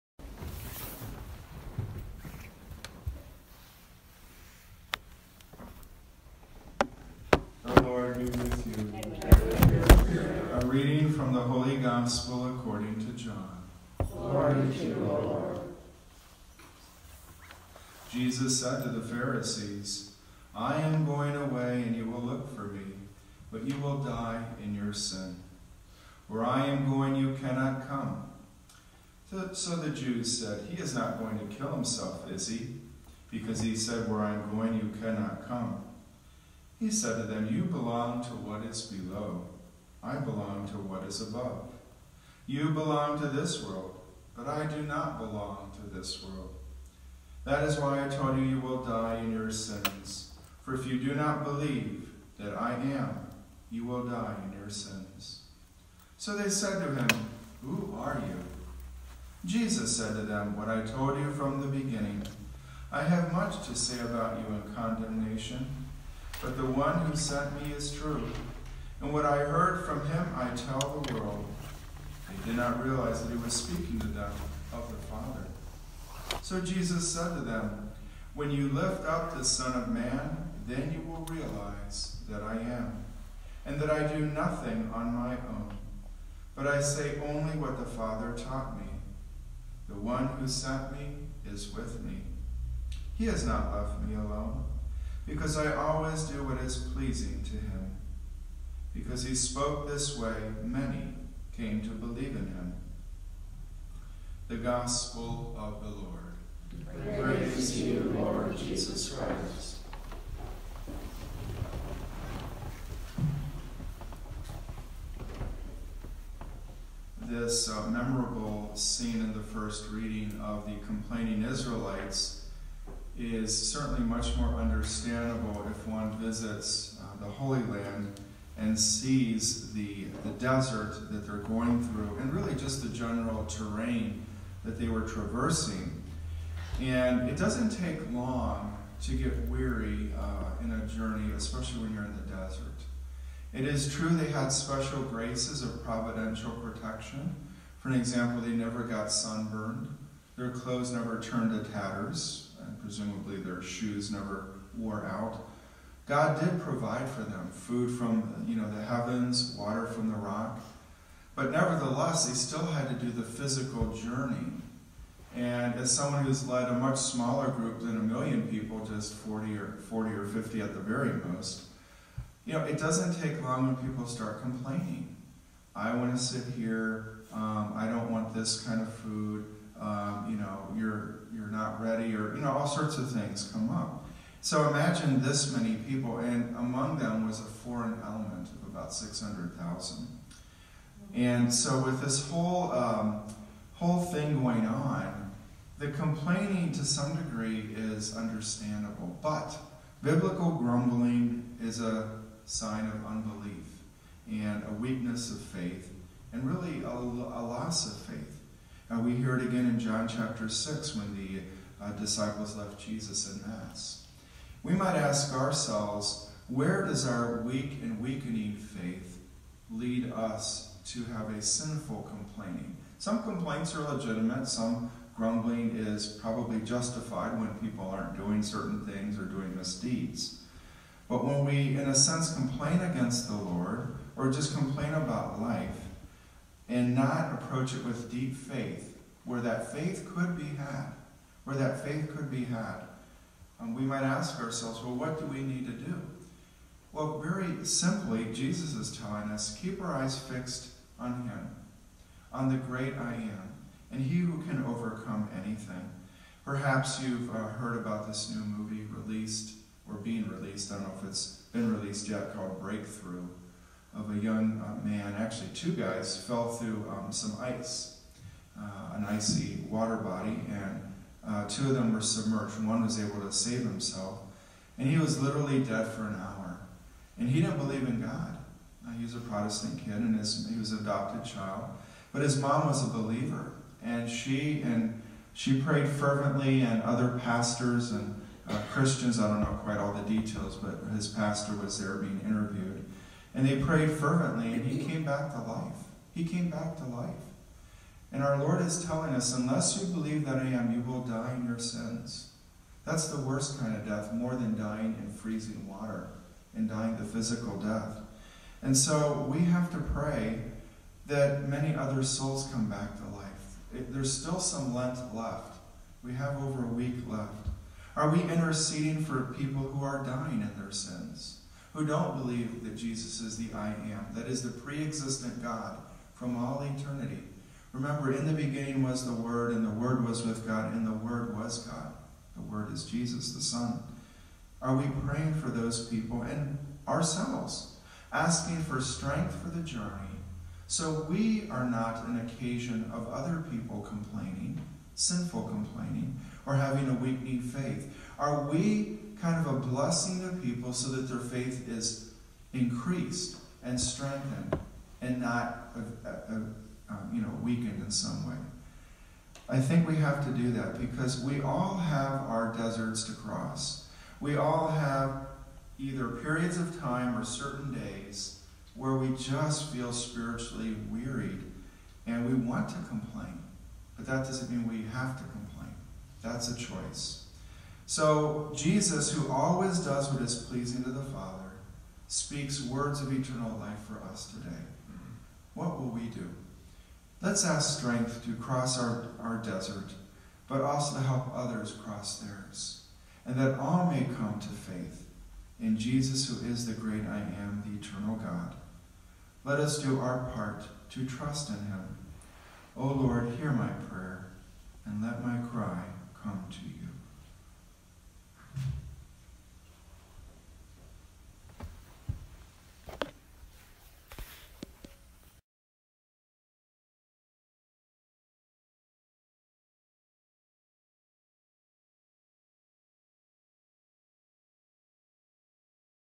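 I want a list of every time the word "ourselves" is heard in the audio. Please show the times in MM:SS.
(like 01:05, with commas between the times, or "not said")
03:35, 04:04, 05:36.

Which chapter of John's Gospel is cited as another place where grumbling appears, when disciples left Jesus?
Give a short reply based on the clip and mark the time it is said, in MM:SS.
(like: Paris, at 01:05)
Chapter 6, at 03:30.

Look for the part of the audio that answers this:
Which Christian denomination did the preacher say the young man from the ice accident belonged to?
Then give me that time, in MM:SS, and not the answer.
04:39.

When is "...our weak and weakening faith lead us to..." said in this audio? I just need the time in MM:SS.
03:37.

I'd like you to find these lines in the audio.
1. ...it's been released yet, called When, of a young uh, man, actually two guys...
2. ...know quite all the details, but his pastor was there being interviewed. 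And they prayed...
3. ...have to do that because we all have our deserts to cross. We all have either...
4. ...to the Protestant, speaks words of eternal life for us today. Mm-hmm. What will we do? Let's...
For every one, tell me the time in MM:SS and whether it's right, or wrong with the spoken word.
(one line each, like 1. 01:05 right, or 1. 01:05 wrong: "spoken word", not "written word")
1. 04:21 wrong: "Breakthrough", not "When"
2. 04:49 right
3. 05:59 right
4. 06:20 wrong: "Father", not "Protestant".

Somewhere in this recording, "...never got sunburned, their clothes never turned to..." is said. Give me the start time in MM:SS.
02:28.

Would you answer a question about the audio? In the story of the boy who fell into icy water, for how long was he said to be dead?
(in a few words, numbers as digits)
An hour.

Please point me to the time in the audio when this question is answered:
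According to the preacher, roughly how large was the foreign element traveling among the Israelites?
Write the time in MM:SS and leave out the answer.
03:08.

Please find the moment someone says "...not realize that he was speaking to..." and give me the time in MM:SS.
01:12.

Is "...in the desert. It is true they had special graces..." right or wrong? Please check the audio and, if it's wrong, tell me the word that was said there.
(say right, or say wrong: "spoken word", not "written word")
right.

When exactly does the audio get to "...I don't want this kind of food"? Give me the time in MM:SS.
02:57.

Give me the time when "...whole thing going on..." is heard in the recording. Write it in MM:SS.
03:13.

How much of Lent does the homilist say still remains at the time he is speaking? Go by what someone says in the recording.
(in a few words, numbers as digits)
Over a week.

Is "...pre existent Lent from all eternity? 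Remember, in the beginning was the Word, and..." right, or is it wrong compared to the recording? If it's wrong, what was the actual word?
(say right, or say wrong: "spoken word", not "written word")
wrong: "God", not "Lent".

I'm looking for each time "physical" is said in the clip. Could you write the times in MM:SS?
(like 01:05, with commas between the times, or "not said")
02:43, 05:07.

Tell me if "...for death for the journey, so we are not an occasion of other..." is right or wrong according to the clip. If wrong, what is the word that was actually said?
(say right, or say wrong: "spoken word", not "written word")
wrong: "strength", not "death".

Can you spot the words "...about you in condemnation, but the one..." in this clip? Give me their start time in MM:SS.
01:04.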